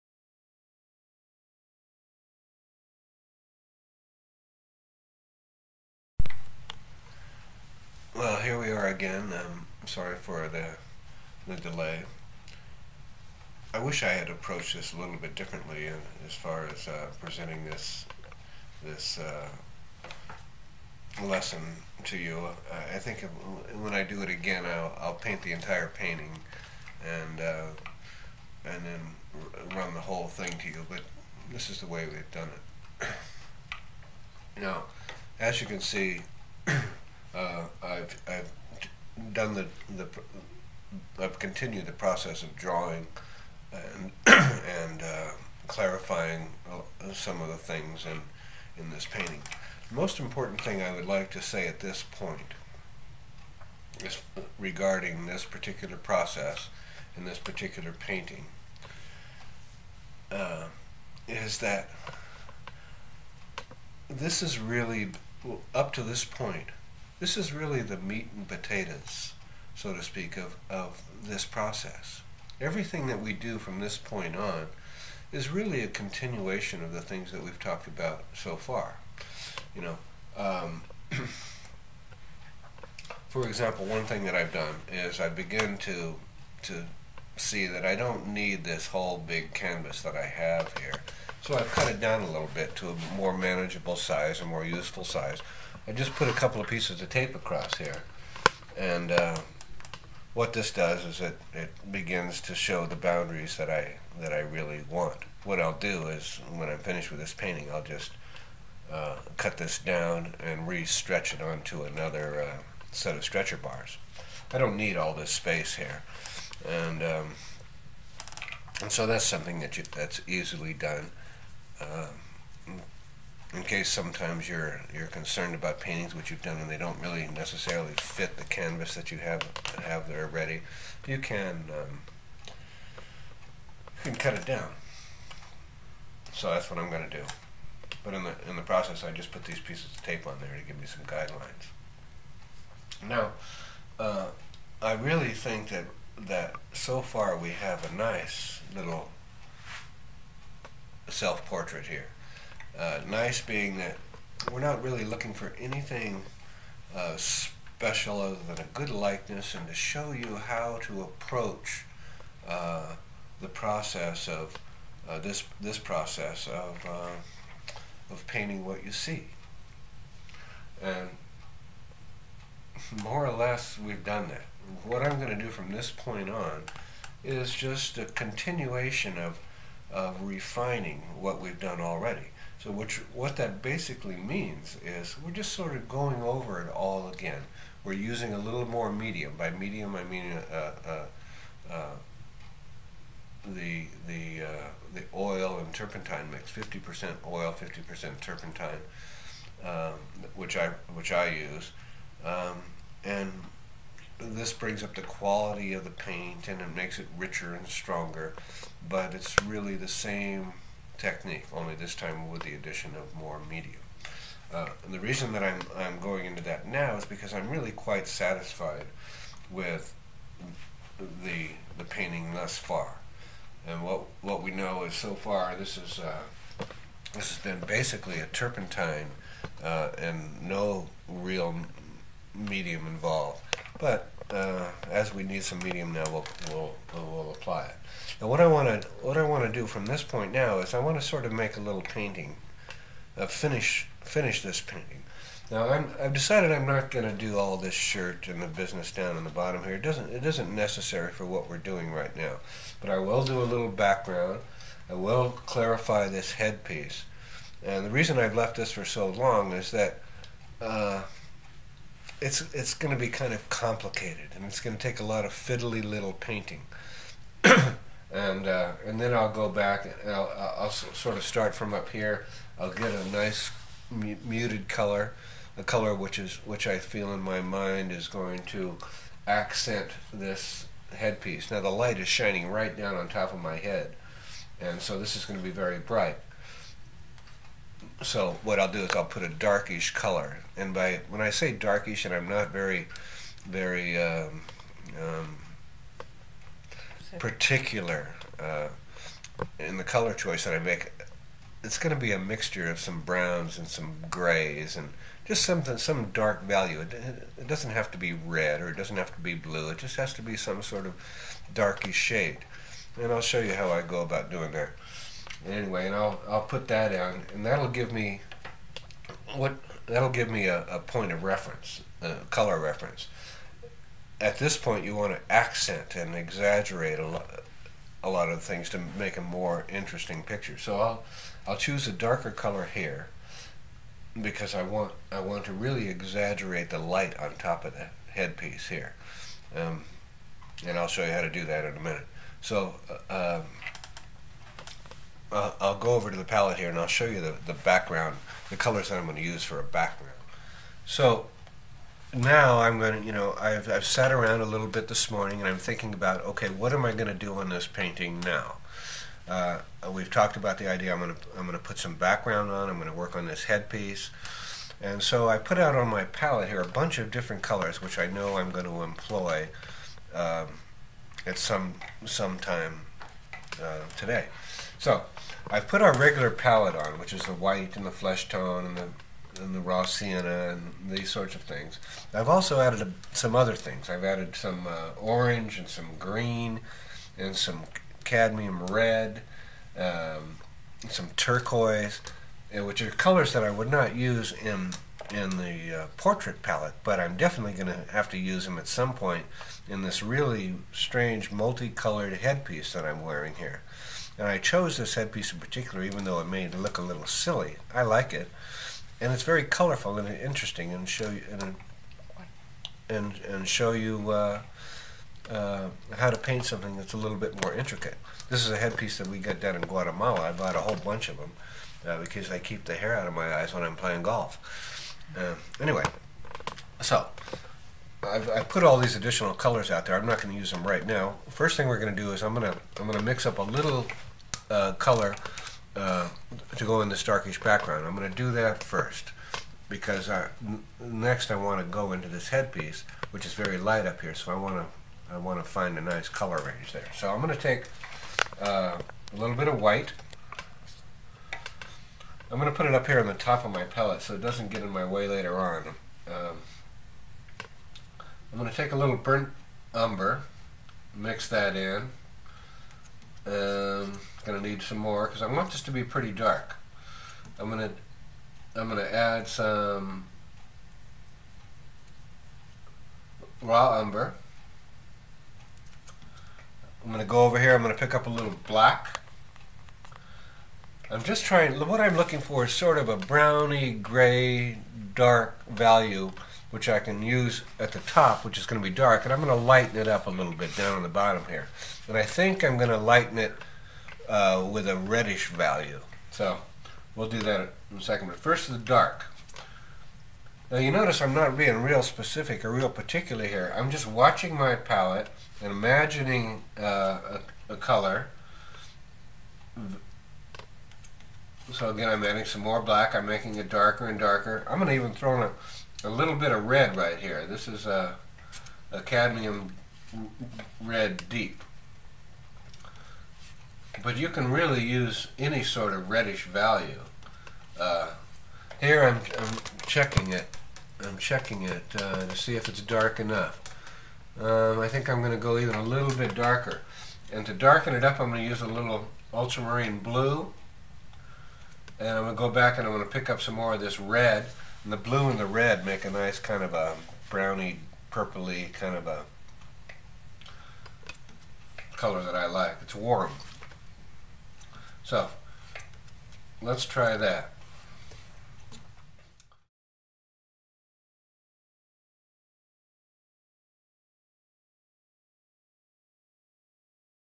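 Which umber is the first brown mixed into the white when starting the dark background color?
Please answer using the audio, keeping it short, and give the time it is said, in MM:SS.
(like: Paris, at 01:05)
burnt umber, at 07:38.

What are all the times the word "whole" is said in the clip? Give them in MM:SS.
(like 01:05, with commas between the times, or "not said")
00:30, 01:28, 07:00.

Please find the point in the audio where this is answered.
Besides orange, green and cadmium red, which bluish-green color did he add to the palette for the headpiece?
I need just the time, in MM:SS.
06:31.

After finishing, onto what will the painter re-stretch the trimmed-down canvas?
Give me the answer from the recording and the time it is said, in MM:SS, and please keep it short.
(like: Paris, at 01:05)
stretcher bars, at 01:53.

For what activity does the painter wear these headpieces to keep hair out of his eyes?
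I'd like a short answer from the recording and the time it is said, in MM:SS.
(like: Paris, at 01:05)
golf, at 07:03.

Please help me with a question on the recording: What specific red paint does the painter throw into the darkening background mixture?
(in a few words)
cadmium red deep.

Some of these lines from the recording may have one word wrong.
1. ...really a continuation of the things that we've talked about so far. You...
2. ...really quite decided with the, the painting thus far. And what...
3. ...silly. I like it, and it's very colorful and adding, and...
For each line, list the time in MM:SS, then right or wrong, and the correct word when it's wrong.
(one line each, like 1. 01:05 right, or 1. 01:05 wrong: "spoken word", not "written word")
1. 01:15 right
2. 03:37 wrong: "satisfied", not "decided"
3. 06:47 wrong: "interesting", not "adding".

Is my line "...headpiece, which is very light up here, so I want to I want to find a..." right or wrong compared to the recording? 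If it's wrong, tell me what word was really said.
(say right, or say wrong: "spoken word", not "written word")
right.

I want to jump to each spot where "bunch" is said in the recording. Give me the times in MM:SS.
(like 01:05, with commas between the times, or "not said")
06:06, 07:00.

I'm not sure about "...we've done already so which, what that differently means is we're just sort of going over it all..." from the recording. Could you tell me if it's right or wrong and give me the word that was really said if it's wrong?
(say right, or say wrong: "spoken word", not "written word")
wrong: "basically", not "differently".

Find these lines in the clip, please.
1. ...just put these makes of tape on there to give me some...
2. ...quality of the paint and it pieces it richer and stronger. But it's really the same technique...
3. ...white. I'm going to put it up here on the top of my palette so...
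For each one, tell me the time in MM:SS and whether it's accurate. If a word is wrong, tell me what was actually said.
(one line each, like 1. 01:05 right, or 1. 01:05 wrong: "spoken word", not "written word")
1. 02:19 wrong: "pieces", not "makes"
2. 03:25 wrong: "makes", not "pieces"
3. 07:29 right.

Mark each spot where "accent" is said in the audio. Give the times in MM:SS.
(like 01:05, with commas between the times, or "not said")
04:39, 05:25.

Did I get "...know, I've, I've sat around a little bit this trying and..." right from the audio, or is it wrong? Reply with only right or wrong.
wrong.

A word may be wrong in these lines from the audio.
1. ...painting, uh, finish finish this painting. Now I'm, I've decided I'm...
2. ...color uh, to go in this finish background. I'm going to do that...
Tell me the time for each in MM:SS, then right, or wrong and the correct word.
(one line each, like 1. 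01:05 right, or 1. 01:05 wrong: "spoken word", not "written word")
1. 04:01 right
2. 07:14 wrong: "darkish", not "finish".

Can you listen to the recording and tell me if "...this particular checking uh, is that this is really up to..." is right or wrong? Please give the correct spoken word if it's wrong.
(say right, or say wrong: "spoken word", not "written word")
wrong: "painting", not "checking".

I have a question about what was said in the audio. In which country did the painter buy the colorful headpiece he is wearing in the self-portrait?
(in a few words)
Guatemala.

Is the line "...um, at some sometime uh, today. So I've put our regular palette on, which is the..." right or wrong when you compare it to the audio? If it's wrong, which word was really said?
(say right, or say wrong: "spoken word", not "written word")
right.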